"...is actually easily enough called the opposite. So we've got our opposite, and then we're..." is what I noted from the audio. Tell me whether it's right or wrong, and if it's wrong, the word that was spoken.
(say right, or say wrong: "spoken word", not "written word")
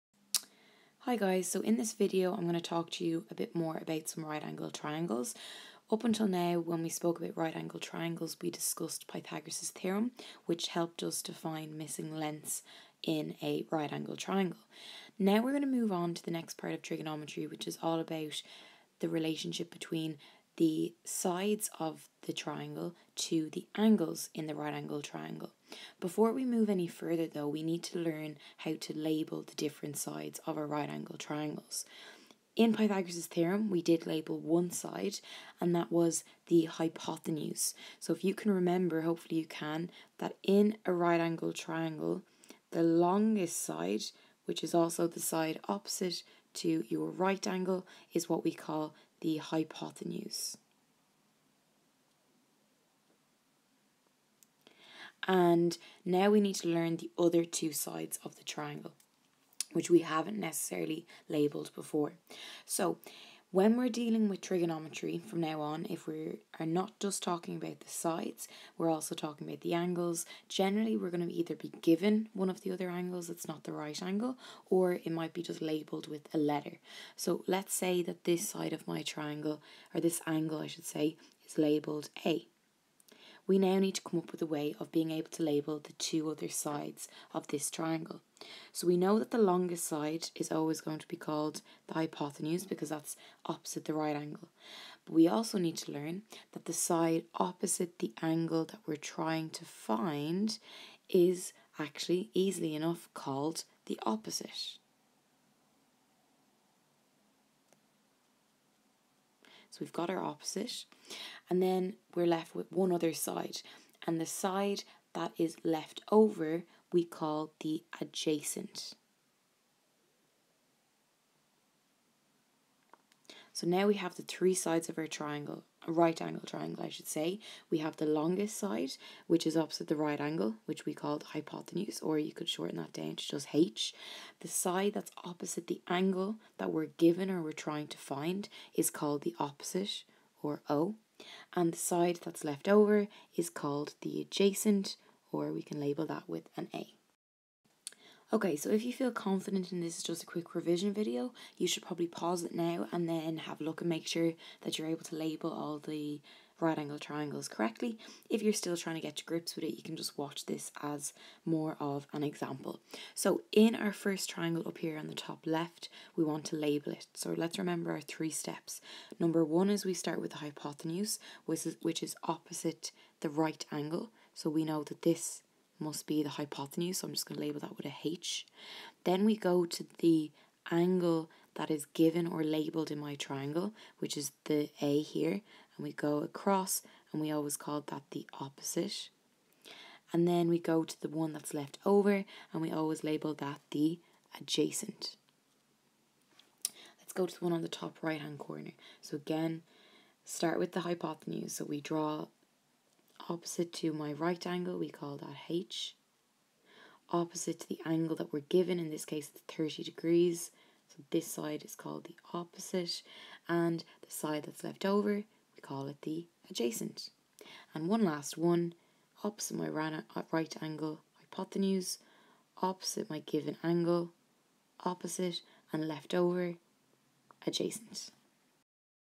right.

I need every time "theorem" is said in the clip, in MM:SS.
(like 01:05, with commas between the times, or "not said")
00:09, 00:33.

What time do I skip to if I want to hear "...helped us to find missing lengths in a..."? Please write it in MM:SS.
00:10.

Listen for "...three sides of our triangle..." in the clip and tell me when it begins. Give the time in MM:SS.
02:04.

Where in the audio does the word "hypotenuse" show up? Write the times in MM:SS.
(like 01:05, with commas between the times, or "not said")
00:36, 00:49, 01:31, 02:11, 02:50, 02:56, 03:20, 03:41.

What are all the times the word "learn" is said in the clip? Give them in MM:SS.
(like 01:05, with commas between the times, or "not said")
00:27, 00:56, 01:35.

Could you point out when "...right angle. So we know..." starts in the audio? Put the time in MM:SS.
02:53.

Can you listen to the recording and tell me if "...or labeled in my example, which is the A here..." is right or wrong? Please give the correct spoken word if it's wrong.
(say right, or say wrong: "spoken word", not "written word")
wrong: "triangle", not "example".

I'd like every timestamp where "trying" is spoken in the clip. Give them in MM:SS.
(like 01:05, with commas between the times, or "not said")
01:38, 02:17, 02:38.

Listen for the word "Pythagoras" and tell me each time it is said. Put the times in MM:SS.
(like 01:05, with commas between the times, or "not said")
00:09, 00:32.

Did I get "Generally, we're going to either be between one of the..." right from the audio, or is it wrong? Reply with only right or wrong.
wrong.